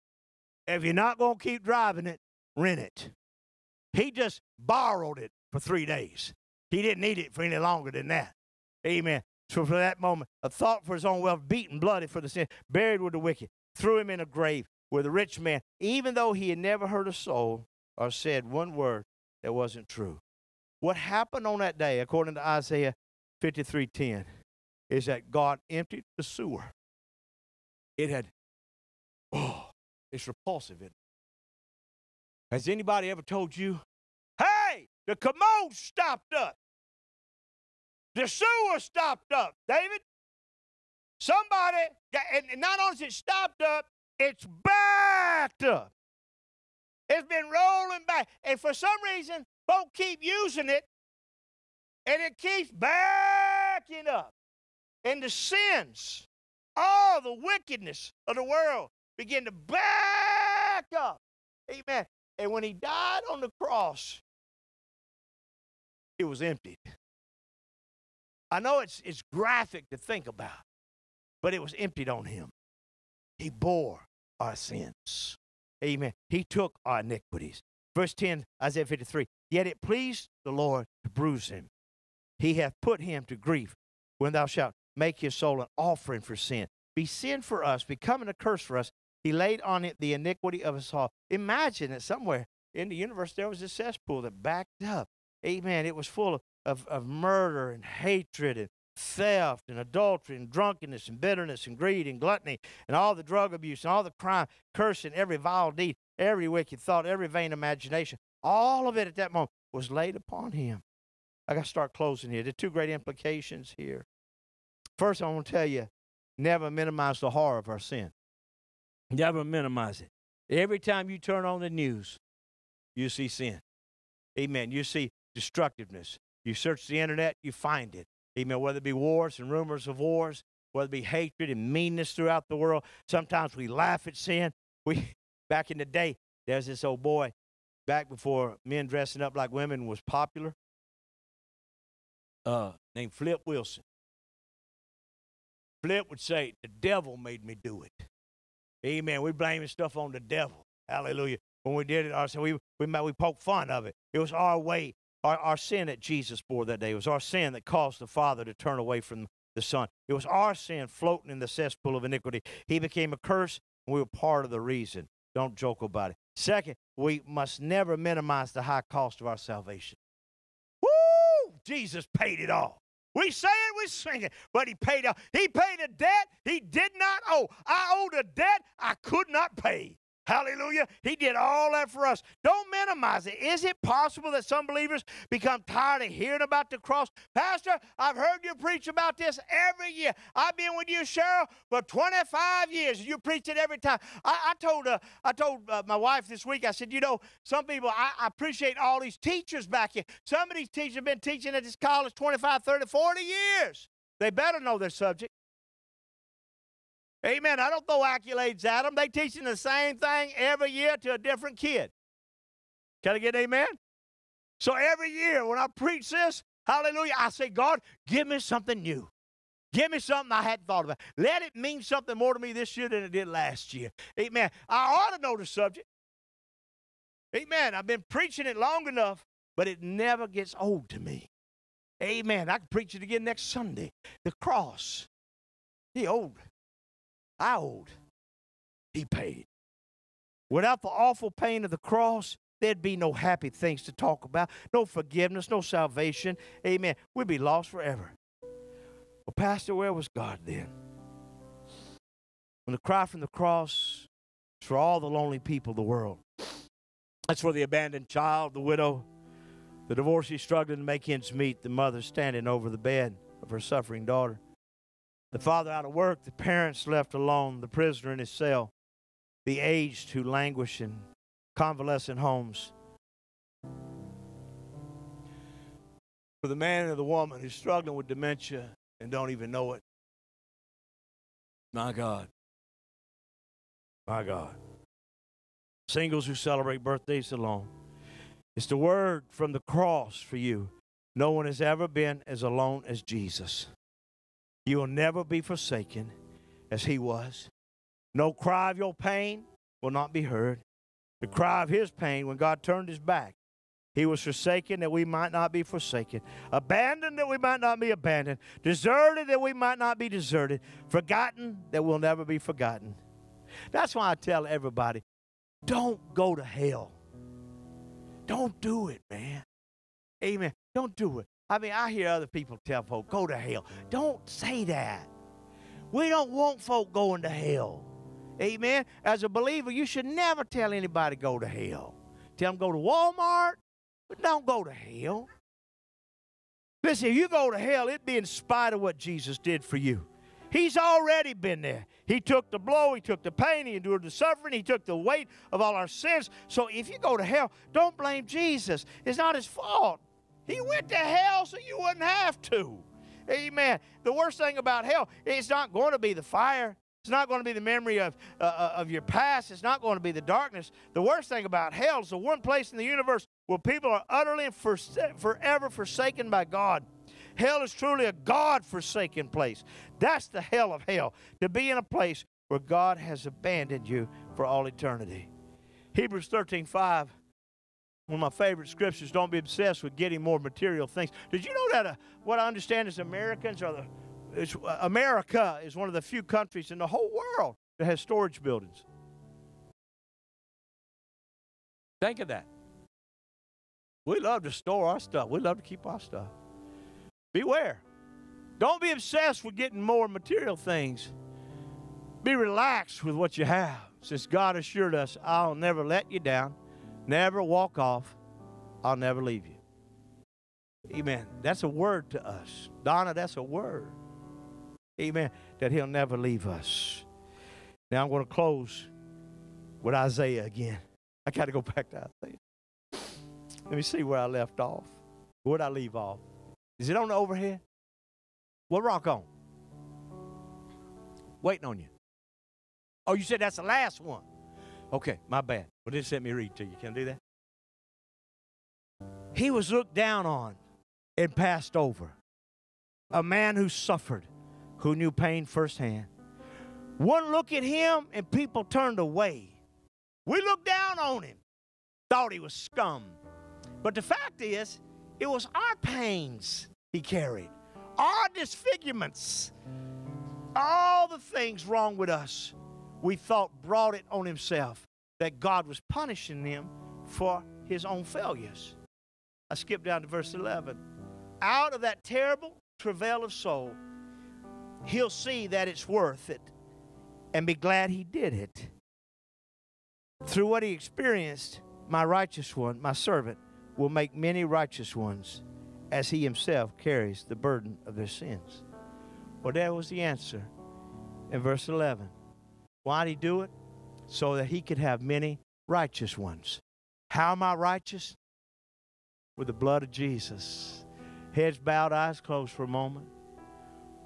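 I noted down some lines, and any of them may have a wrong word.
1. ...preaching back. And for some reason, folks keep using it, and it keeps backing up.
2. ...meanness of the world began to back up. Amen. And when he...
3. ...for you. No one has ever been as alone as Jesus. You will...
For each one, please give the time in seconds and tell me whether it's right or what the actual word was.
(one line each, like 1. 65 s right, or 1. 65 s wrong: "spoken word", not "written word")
1. 47 s wrong: "rolling", not "preaching"
2. 57 s wrong: "wickedness", not "meanness"
3. 290 s right.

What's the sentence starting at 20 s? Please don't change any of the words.
What happened on that day, according to Isaiah 53:10, is that God emptied the sewer it had, oh, it's repulsive, it?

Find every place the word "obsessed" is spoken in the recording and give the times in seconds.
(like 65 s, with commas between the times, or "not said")
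379 s, 398 s.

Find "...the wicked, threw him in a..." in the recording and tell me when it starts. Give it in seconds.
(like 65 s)
13 s.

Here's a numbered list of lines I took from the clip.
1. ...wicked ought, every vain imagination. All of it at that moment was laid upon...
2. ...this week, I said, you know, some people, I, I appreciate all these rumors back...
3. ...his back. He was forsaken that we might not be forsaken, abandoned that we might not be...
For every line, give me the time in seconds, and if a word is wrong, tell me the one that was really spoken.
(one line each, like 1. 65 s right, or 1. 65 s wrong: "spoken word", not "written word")
1. 106 s wrong: "thought", not "ought"
2. 196 s wrong: "teachers", not "rumors"
3. 302 s right.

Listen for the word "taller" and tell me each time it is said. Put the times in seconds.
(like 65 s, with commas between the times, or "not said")
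not said.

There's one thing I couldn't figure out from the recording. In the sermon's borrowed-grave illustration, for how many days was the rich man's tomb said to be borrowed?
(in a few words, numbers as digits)
3.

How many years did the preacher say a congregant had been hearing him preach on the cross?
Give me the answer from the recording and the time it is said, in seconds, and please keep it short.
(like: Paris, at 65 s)
25, at 191 s.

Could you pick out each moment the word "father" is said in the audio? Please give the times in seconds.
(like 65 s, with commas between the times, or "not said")
158 s, 265 s.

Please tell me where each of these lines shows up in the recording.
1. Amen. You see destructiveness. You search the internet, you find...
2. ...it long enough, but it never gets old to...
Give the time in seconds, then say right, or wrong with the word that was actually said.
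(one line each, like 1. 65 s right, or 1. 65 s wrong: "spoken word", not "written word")
1. 124 s right
2. 228 s right.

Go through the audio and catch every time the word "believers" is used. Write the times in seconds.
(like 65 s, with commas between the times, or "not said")
184 s, 329 s.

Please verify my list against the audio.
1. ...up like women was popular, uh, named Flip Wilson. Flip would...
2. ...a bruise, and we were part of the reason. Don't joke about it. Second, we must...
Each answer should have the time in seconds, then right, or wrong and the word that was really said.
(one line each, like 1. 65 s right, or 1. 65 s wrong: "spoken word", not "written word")
1. 139 s right
2. 163 s wrong: "curse", not "bruise".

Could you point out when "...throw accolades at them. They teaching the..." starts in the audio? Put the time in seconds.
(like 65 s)
207 s.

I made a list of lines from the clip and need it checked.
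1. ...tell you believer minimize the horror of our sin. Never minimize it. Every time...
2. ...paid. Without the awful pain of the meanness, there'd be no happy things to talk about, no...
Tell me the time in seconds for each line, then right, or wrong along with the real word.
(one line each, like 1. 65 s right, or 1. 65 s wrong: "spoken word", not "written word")
1. 115 s wrong: "never", not "believer"
2. 239 s wrong: "cross", not "meanness".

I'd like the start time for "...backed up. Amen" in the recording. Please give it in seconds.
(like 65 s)
94 s.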